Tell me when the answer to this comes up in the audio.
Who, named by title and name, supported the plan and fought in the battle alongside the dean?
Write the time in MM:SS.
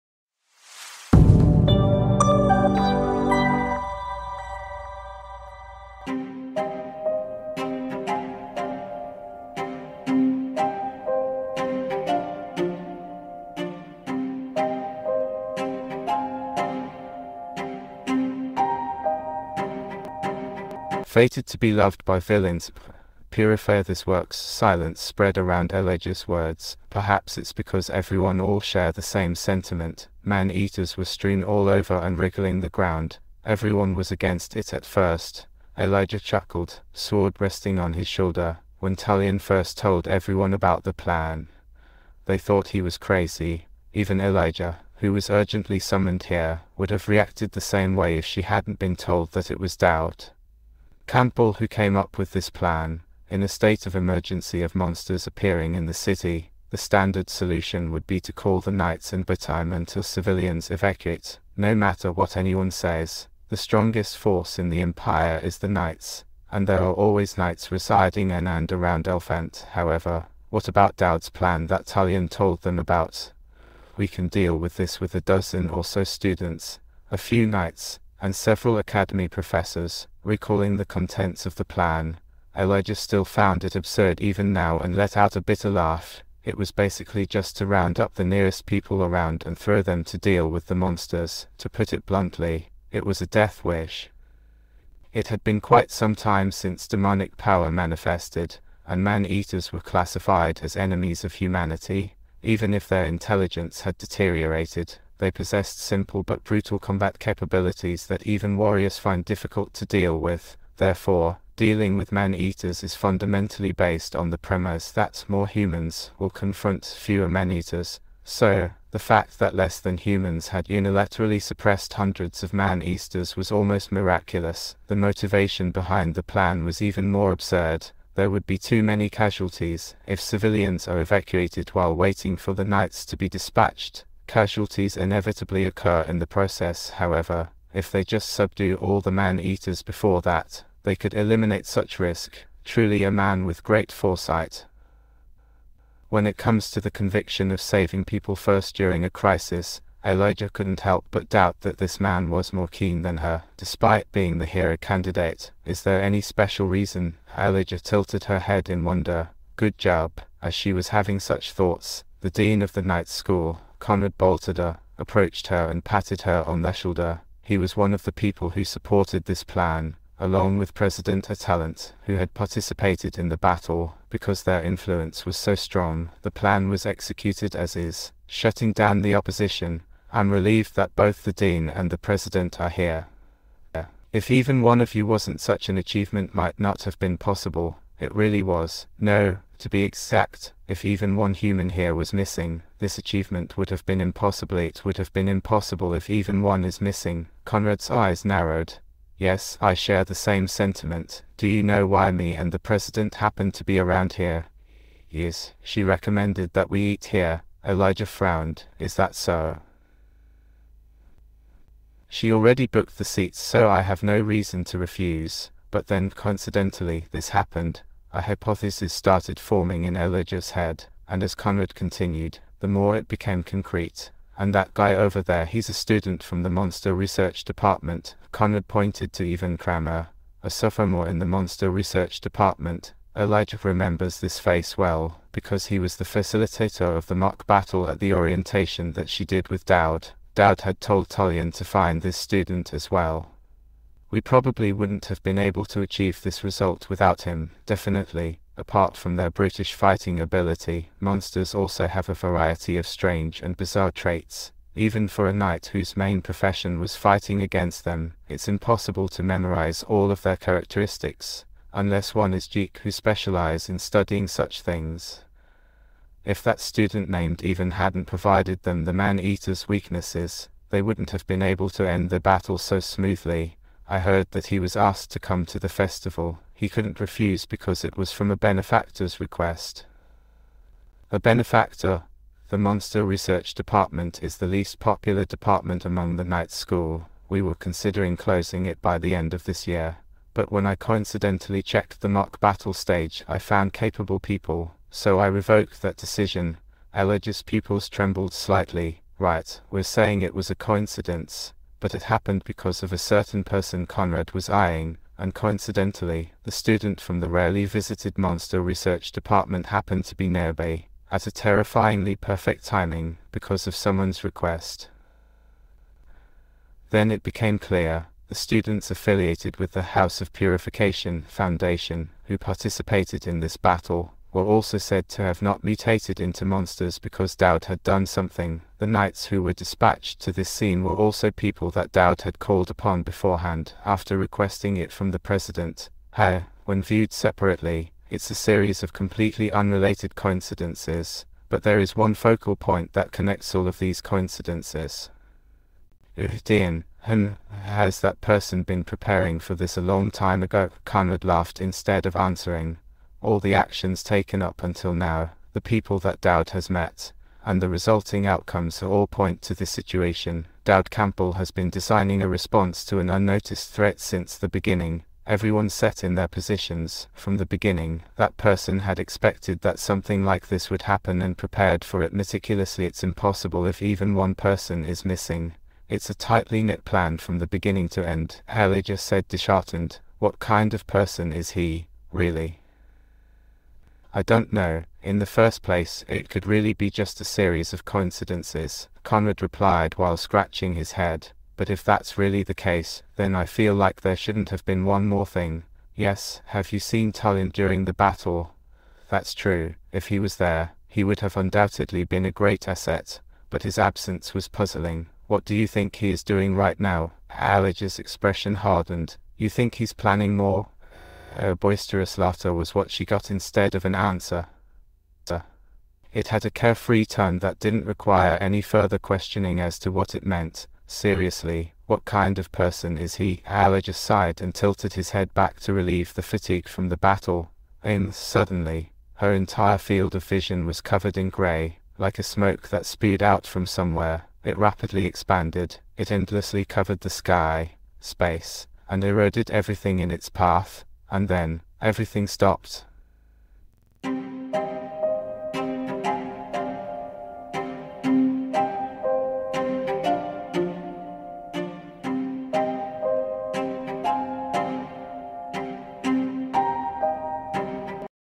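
02:50.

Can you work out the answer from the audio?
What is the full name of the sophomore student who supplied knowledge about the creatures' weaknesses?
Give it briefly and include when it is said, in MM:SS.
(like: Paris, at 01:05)
Ivan Kramer, at 03:49.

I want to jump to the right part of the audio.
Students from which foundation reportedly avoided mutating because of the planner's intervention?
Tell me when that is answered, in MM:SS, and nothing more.
05:19.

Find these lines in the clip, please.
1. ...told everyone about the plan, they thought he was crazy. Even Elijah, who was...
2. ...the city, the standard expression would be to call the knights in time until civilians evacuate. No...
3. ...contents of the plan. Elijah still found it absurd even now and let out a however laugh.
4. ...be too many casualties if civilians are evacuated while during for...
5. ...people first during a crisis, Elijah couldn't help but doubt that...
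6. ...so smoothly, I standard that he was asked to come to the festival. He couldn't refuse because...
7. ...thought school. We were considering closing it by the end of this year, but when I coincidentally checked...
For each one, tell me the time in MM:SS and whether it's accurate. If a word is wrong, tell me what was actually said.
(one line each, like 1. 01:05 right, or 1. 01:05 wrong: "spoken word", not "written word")
1. 00:39 right
2. 00:55 wrong: "solution", not "expression"
3. 01:20 wrong: "bitter", not "however"
4. 02:08 wrong: "waiting", not "during"
5. 02:28 right
6. 04:32 wrong: "heard", not "standard"
7. 04:46 wrong: "night", not "thought".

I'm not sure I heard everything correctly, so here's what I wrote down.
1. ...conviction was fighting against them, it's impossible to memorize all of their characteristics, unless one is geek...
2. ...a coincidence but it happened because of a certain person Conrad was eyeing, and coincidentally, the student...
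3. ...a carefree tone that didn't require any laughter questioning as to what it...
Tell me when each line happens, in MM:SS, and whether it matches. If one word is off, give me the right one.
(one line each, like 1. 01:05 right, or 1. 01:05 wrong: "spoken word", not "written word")
1. 04:16 wrong: "profession", not "conviction"
2. 05:00 right
3. 06:56 wrong: "further", not "laughter".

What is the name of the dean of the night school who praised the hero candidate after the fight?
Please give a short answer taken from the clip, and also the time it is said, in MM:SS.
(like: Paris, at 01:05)
Conrad Baltada, at 02:43.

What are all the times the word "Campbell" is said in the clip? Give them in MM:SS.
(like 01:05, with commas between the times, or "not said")
00:51, 06:00.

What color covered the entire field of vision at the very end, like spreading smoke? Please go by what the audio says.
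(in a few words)
Grey.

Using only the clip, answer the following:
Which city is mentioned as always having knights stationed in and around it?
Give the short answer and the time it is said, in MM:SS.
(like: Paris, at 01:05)
Elfant, at 01:09.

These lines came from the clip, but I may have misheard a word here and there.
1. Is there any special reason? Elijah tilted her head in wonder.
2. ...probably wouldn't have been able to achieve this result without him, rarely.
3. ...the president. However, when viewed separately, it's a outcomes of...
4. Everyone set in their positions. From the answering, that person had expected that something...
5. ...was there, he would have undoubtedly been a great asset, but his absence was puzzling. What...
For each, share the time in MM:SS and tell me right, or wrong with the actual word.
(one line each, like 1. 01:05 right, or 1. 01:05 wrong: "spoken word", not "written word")
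1. 02:35 right
2. 04:04 wrong: "definitely", not "rarely"
3. 05:35 wrong: "series", not "outcomes"
4. 06:05 wrong: "beginning", not "answering"
5. 06:40 right.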